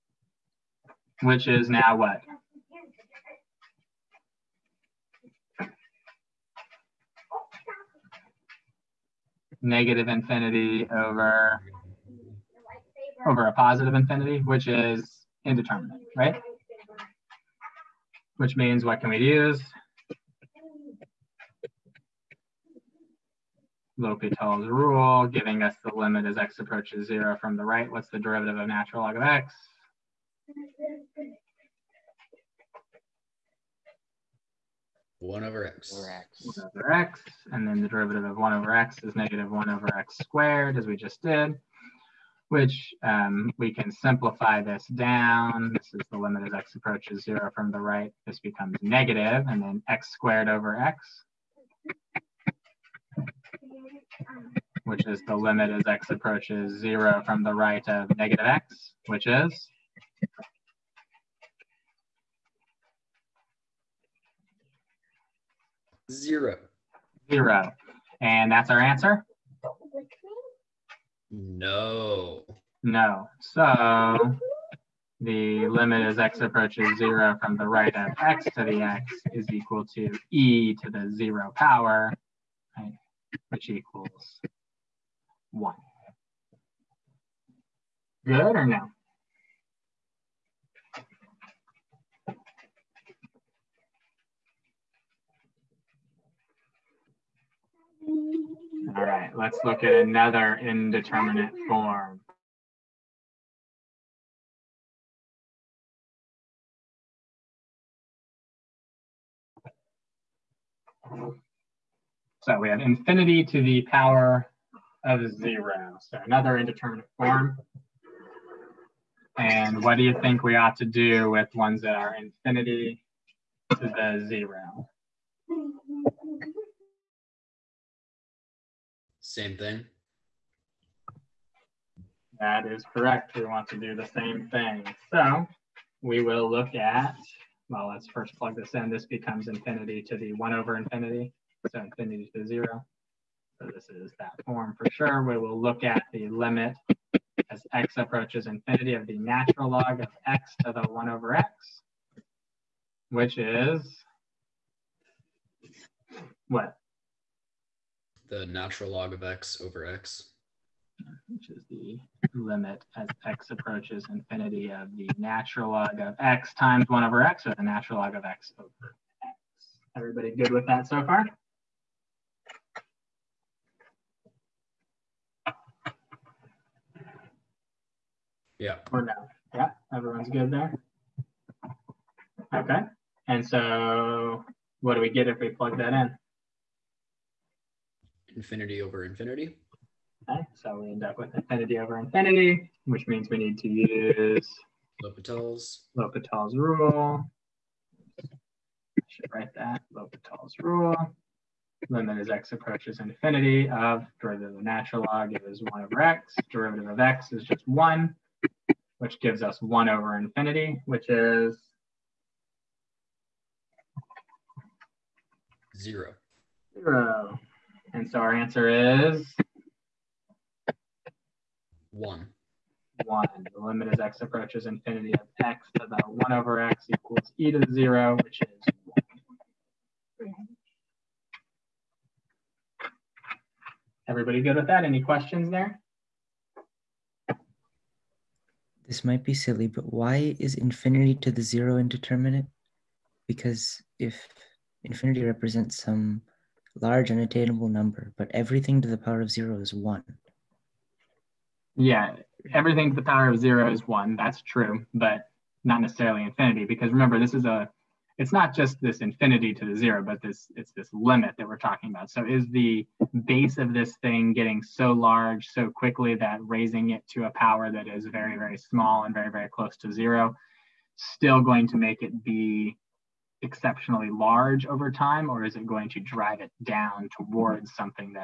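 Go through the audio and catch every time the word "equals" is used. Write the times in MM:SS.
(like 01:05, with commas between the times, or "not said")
01:19, 01:23, 03:46.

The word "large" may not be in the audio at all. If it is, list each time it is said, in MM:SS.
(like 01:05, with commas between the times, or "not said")
04:06, 04:24, 04:34.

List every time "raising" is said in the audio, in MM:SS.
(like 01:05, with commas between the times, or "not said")
04:26.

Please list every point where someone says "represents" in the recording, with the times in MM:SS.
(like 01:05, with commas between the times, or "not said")
04:05.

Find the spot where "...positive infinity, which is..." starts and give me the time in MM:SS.
00:13.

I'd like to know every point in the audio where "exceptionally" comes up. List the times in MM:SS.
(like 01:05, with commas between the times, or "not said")
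04:33.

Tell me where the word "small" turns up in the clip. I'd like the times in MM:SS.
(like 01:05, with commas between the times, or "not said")
04:28.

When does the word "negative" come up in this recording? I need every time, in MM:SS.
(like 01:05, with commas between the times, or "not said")
00:09, 00:39, 00:48, 00:58.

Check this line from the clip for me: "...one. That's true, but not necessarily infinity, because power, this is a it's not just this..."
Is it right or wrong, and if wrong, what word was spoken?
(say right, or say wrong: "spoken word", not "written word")
wrong: "remember", not "power".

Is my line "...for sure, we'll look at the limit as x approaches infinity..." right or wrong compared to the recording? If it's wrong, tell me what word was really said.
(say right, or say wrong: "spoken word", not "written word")
right.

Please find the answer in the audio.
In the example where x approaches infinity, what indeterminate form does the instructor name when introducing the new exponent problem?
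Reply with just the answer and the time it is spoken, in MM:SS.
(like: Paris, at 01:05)
infinity to the power of zero, at 01:52.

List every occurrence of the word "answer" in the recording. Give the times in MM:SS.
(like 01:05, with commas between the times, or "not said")
01:08, 03:38.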